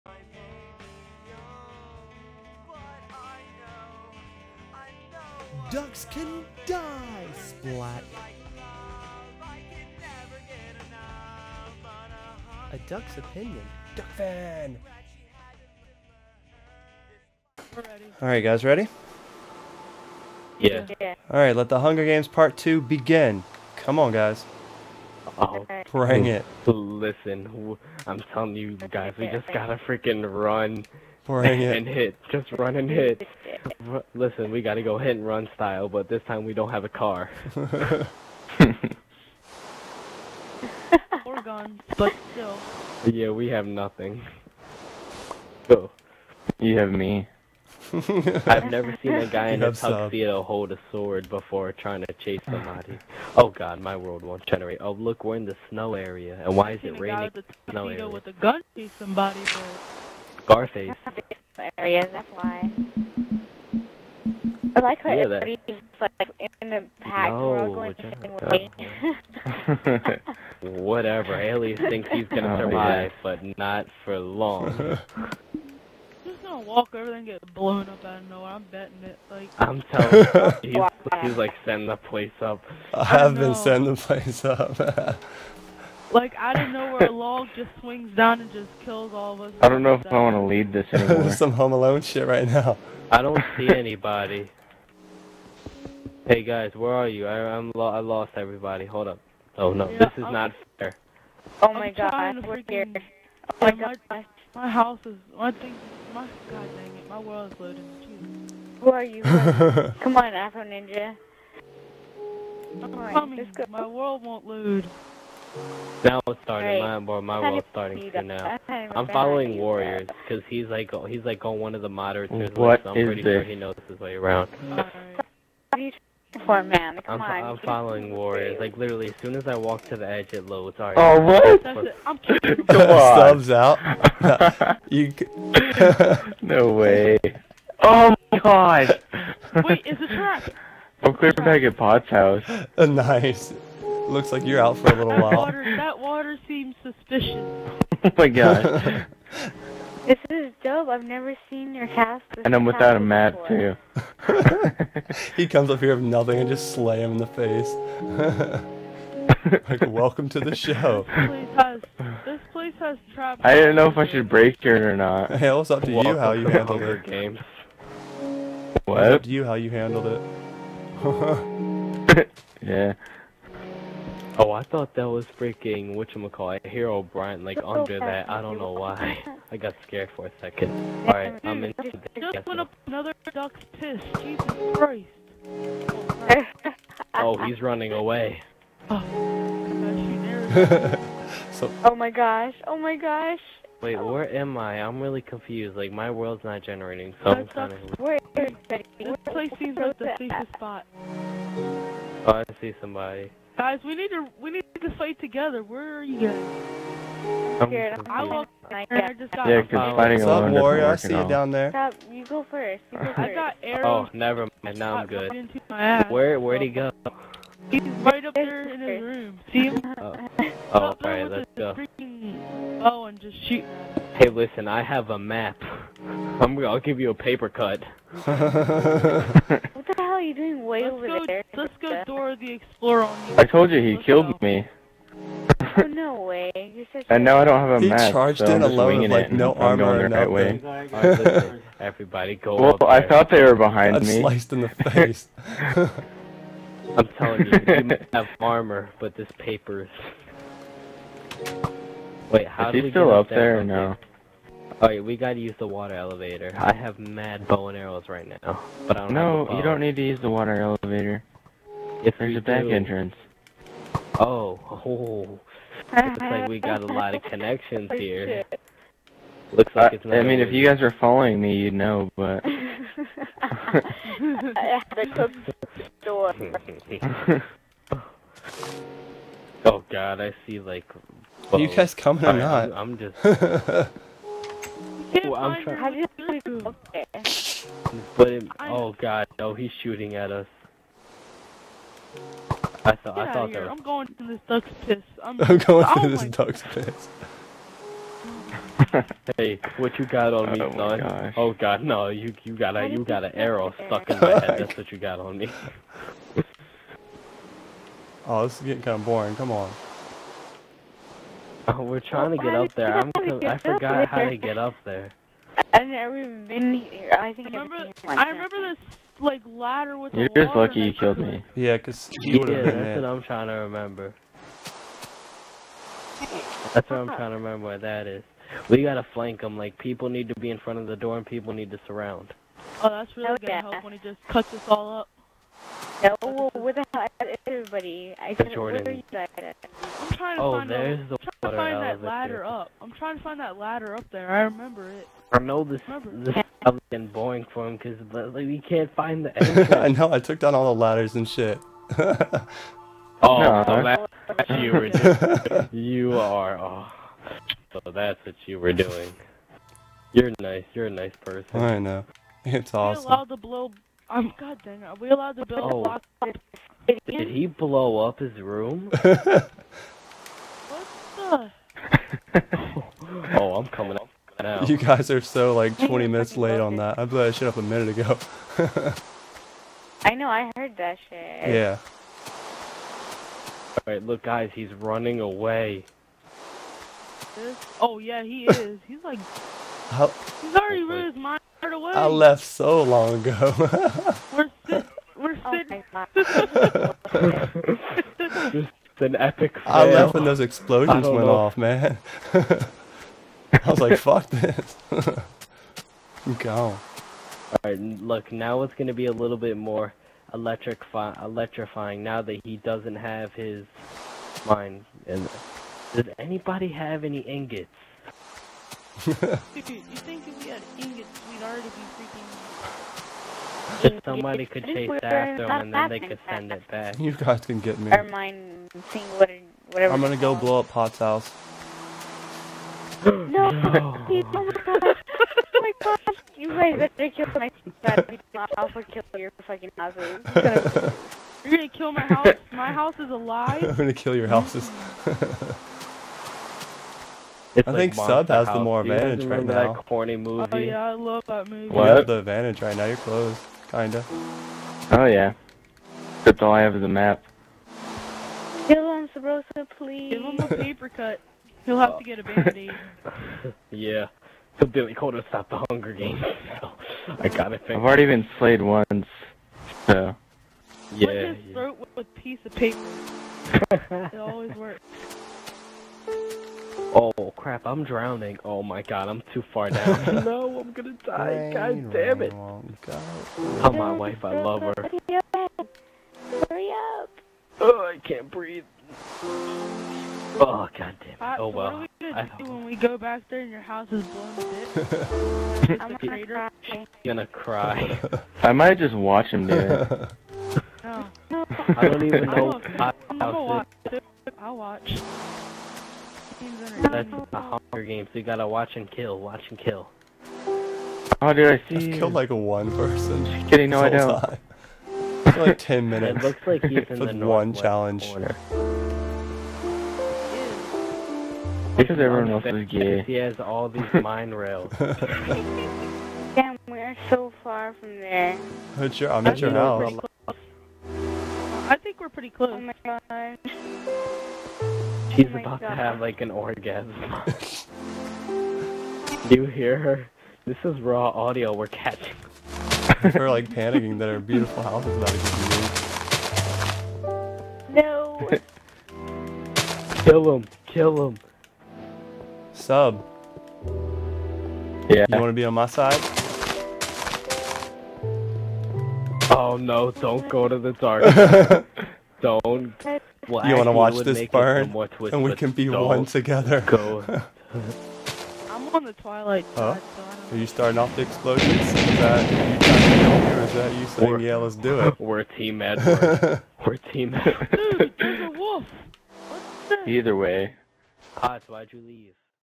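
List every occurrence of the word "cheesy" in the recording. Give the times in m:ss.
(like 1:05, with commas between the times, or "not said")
not said.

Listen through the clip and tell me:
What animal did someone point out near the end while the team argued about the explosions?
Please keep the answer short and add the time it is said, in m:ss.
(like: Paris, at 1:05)
a wolf, at 9:38.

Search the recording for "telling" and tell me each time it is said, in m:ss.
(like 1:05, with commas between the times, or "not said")
0:28, 1:19, 4:07.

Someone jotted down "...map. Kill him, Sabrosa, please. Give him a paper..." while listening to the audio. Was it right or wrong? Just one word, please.
right.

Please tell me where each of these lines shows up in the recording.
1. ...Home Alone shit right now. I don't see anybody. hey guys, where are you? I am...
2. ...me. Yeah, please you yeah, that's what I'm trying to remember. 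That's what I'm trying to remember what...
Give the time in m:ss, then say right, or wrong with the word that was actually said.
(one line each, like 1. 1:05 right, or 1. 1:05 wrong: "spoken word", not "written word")
1. 1:31 right
2. 5:21 wrong: "cause", not "please".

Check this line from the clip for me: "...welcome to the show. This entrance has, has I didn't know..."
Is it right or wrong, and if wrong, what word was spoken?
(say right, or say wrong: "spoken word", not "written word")
wrong: "place", not "entrance".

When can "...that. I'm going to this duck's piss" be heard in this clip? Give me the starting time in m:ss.
4:53.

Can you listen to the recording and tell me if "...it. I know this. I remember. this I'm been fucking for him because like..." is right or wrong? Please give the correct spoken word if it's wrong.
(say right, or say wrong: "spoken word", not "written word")
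wrong: "boring", not "fucking".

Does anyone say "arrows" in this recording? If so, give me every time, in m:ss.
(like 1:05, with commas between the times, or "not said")
3:33, 4:17, 5:03.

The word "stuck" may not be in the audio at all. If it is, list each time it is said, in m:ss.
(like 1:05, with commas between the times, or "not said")
5:03.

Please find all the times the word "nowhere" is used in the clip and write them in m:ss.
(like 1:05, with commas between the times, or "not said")
1:18, 1:26.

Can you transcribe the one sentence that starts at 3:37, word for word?
He's right up there in his room.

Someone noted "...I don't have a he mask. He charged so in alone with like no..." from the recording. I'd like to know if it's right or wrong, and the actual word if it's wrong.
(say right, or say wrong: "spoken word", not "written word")
right.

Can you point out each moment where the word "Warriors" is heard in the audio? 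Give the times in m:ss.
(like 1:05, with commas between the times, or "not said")
1:59, 2:08, 3:30.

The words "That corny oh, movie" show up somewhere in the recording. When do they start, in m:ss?
7:29.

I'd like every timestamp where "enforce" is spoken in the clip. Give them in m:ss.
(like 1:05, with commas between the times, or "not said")
not said.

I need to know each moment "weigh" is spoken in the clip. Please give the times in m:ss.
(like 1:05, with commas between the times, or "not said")
not said.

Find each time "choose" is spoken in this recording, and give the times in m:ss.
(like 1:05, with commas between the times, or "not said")
not said.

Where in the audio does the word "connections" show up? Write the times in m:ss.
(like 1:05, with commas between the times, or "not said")
4:27.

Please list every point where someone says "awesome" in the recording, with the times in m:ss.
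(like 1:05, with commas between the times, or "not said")
6:02.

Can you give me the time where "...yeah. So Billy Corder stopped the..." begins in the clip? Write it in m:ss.
7:43.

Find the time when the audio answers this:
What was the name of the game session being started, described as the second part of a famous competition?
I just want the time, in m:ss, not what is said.
0:21.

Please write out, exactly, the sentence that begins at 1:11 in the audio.
Alias thinks he's gonna oh, survive, yeah.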